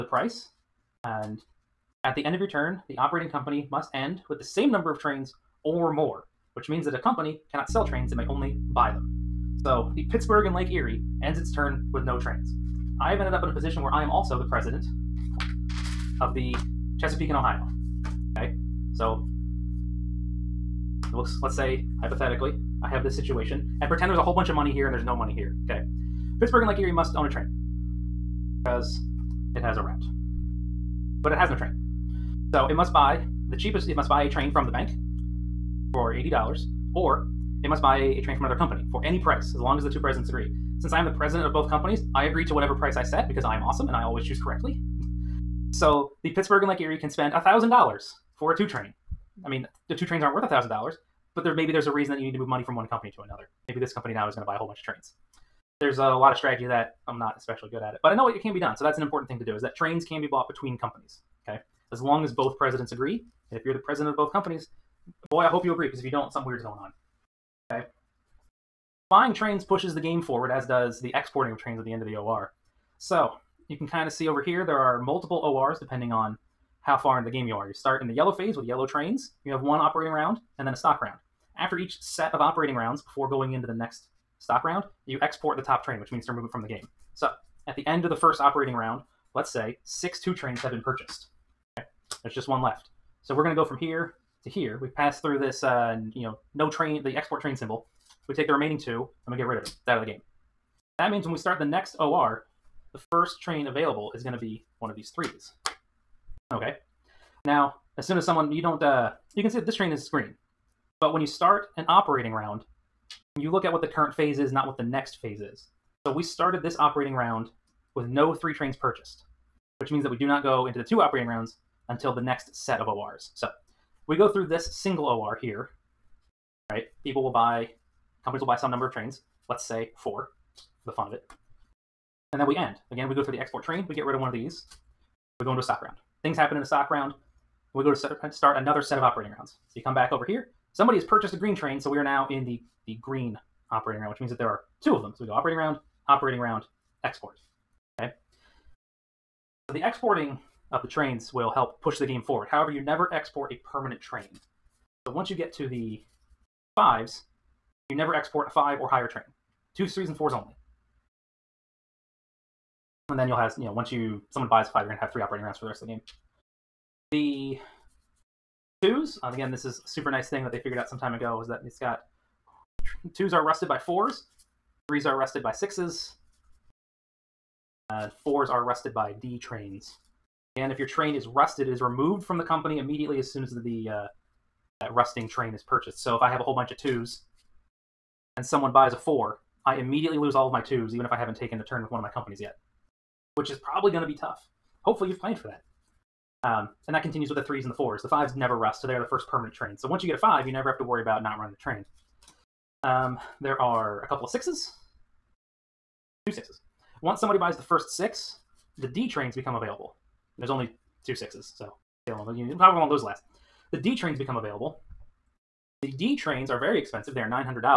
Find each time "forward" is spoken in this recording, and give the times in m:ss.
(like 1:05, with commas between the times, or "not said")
1:10, 2:32.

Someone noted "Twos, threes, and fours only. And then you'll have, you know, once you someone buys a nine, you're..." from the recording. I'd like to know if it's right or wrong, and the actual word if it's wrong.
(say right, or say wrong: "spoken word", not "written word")
wrong: "five", not "nine".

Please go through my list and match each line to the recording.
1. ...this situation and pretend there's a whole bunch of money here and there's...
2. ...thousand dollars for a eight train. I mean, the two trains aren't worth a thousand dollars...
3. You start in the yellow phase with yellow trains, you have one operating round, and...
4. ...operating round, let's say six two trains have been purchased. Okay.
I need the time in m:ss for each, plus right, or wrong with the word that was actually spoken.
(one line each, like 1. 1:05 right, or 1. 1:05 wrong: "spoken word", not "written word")
1. 0:23 right
2. 0:47 wrong: "two", not "eight"
3. 1:17 right
4. 1:28 right.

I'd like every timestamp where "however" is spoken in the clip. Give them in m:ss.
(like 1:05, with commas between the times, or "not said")
2:32, 3:32.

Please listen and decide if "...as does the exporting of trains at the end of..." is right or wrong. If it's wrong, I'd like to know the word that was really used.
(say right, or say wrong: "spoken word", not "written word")
right.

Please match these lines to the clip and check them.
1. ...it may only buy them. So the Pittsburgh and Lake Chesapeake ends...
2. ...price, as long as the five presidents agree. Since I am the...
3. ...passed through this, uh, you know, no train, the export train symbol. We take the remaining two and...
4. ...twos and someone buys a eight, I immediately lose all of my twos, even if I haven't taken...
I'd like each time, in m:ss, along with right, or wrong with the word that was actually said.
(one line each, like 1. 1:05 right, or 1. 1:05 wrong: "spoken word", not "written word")
1. 0:08 wrong: "Erie", not "Chesapeake"
2. 0:39 wrong: "two", not "five"
3. 1:34 right
4. 3:06 wrong: "four", not "eight".